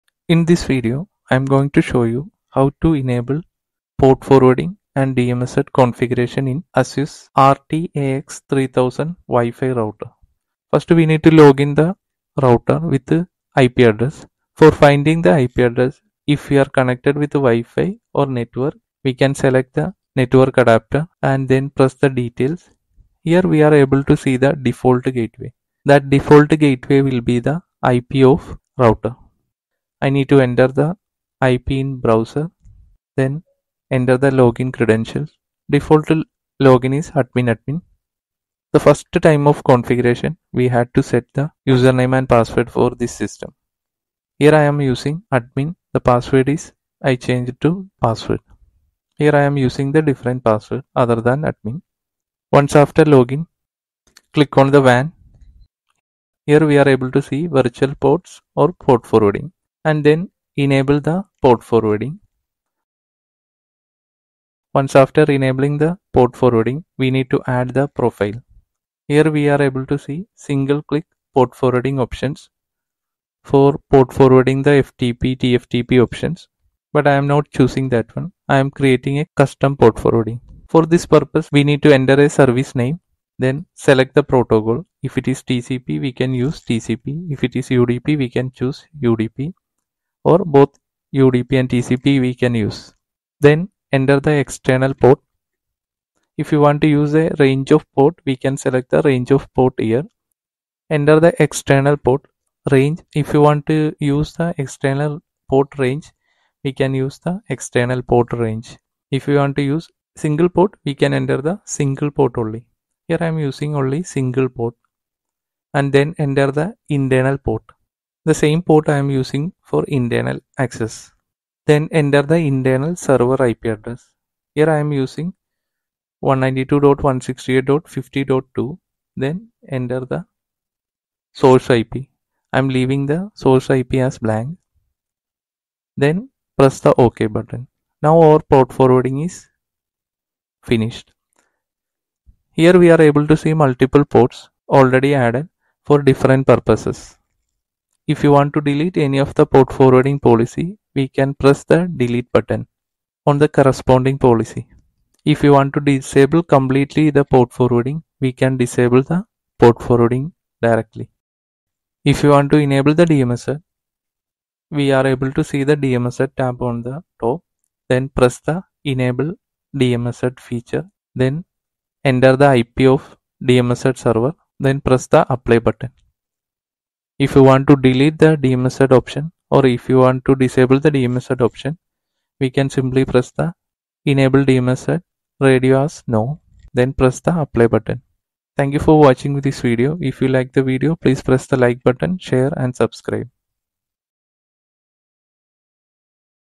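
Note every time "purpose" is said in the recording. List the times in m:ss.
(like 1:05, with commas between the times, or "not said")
1:21, 2:26.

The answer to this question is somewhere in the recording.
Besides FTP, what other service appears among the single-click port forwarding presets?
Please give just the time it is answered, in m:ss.
1:15.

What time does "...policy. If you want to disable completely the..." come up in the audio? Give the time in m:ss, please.
2:34.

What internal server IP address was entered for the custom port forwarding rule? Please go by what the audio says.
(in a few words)
192.168.50.2.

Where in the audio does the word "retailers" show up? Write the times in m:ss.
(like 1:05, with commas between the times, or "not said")
not said.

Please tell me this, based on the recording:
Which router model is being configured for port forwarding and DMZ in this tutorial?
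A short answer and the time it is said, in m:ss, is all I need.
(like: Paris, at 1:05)
ASUS RTAX3000, at 0:06.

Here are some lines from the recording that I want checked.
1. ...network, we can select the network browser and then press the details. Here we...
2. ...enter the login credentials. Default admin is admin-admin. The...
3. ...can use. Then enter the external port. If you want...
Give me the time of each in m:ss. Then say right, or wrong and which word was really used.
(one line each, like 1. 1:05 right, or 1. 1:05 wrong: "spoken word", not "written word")
1. 0:18 wrong: "adapter", not "browser"
2. 0:33 wrong: "login", not "admin"
3. 1:32 right.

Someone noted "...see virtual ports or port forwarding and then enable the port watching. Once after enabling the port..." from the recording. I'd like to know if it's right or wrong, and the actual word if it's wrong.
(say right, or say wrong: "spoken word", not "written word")
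wrong: "forwarding", not "watching".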